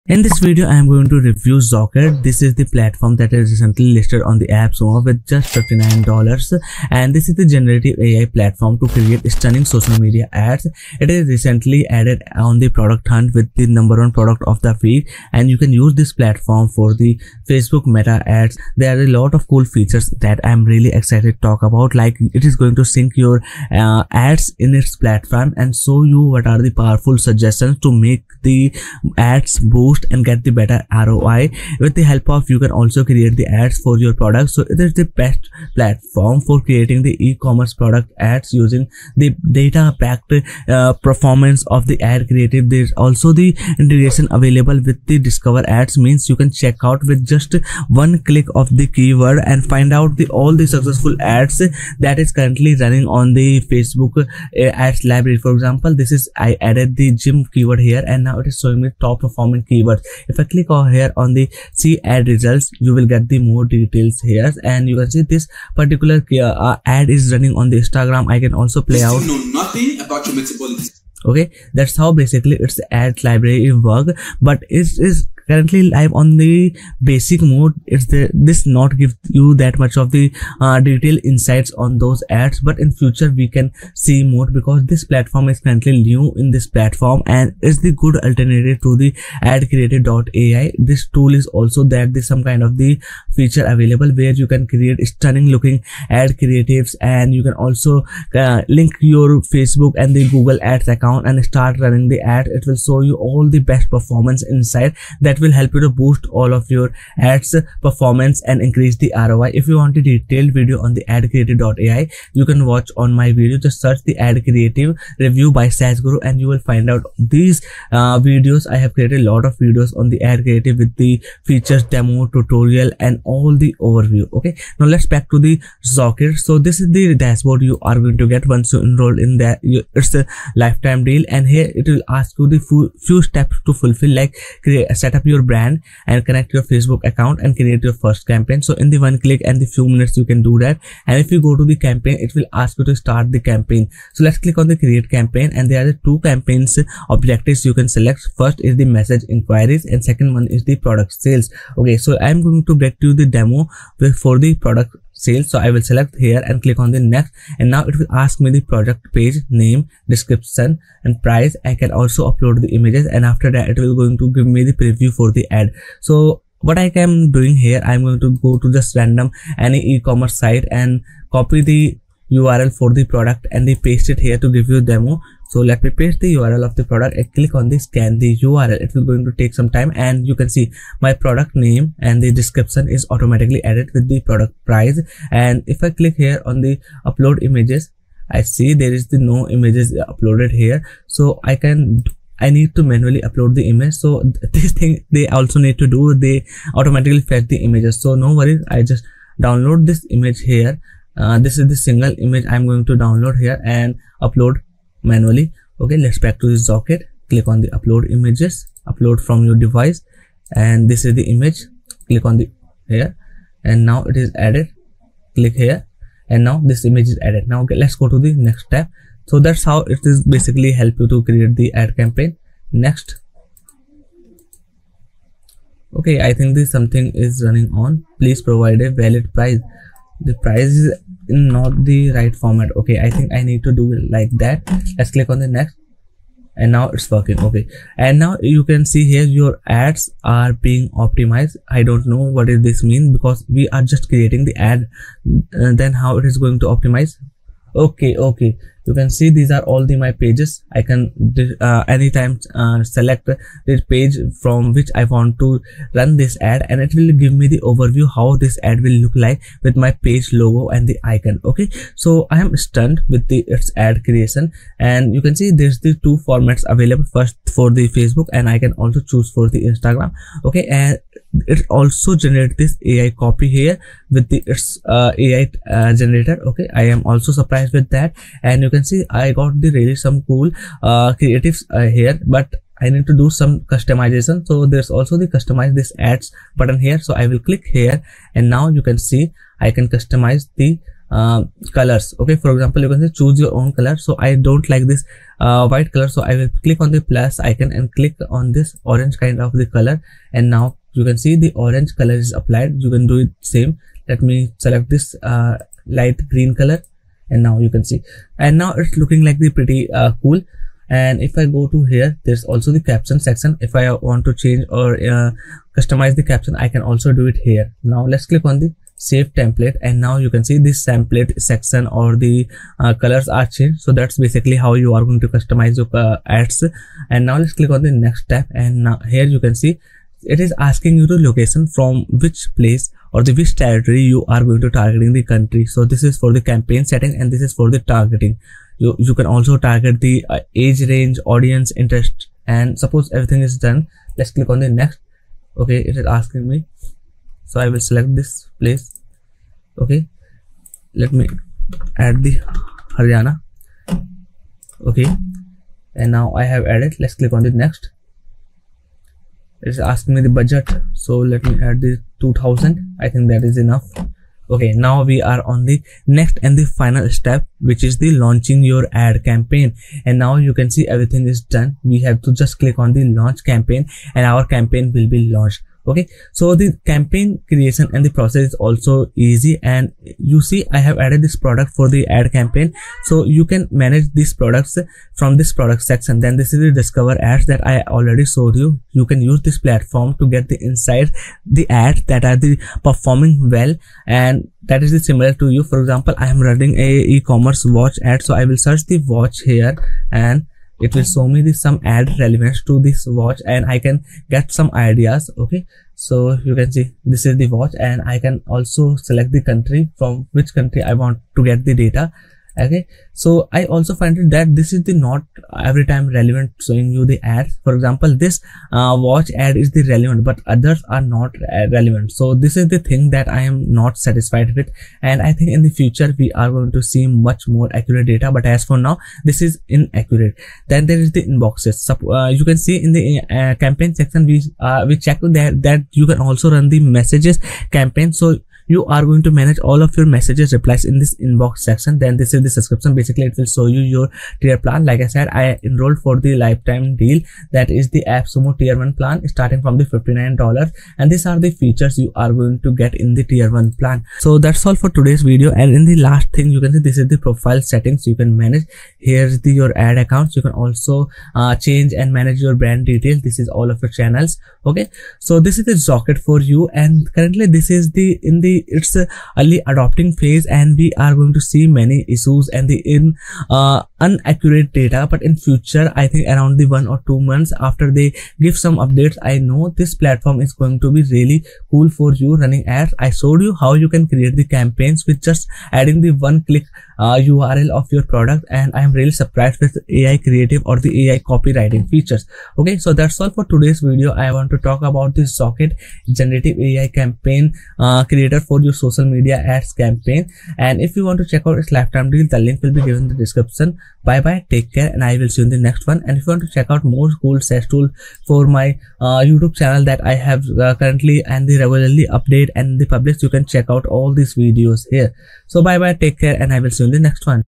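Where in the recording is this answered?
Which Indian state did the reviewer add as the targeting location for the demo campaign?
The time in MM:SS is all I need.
05:52.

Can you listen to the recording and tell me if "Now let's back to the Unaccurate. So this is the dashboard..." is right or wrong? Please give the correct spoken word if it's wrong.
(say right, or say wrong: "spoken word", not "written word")
wrong: "Zocket", not "Unaccurate".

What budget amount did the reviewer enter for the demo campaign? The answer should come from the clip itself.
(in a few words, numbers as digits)
2000.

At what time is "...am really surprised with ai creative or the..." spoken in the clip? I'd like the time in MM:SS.
08:08.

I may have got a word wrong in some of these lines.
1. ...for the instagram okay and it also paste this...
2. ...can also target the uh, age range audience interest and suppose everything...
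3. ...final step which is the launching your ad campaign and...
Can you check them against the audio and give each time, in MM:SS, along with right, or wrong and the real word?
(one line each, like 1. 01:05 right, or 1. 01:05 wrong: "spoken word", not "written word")
1. 04:29 wrong: "generate", not "paste"
2. 05:39 right
3. 06:06 right.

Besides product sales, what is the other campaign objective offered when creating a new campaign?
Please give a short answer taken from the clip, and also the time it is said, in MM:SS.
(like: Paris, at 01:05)
message inquiries, at 02:28.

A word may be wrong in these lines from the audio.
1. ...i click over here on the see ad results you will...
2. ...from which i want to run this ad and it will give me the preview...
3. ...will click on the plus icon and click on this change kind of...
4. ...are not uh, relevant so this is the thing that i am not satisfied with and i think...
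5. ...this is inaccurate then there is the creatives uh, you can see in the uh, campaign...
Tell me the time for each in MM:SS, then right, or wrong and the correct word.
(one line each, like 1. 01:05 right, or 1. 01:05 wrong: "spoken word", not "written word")
1. 01:00 right
2. 04:14 wrong: "overview", not "preview"
3. 04:56 wrong: "orange", not "change"
4. 07:00 right
5. 07:09 wrong: "inboxes", not "creatives".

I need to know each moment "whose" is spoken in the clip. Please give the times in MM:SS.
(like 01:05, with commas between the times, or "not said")
not said.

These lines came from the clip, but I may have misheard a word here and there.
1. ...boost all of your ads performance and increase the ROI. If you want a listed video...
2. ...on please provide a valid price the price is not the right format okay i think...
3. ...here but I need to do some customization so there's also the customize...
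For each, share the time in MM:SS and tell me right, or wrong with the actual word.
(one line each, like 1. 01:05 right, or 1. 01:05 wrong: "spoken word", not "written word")
1. 01:45 wrong: "detailed", not "listed"
2. 03:47 right
3. 04:41 right.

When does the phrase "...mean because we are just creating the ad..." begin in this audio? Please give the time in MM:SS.
04:02.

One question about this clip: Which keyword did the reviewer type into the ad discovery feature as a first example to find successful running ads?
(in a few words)
gym.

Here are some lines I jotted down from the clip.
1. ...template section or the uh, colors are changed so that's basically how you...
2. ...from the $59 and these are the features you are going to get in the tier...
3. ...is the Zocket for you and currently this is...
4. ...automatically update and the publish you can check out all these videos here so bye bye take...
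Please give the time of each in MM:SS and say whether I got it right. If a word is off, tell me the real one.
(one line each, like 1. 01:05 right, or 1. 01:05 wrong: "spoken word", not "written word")
1. 05:20 right
2. 07:29 right
3. 07:45 right
4. 08:31 wrong: "regularly", not "automatically".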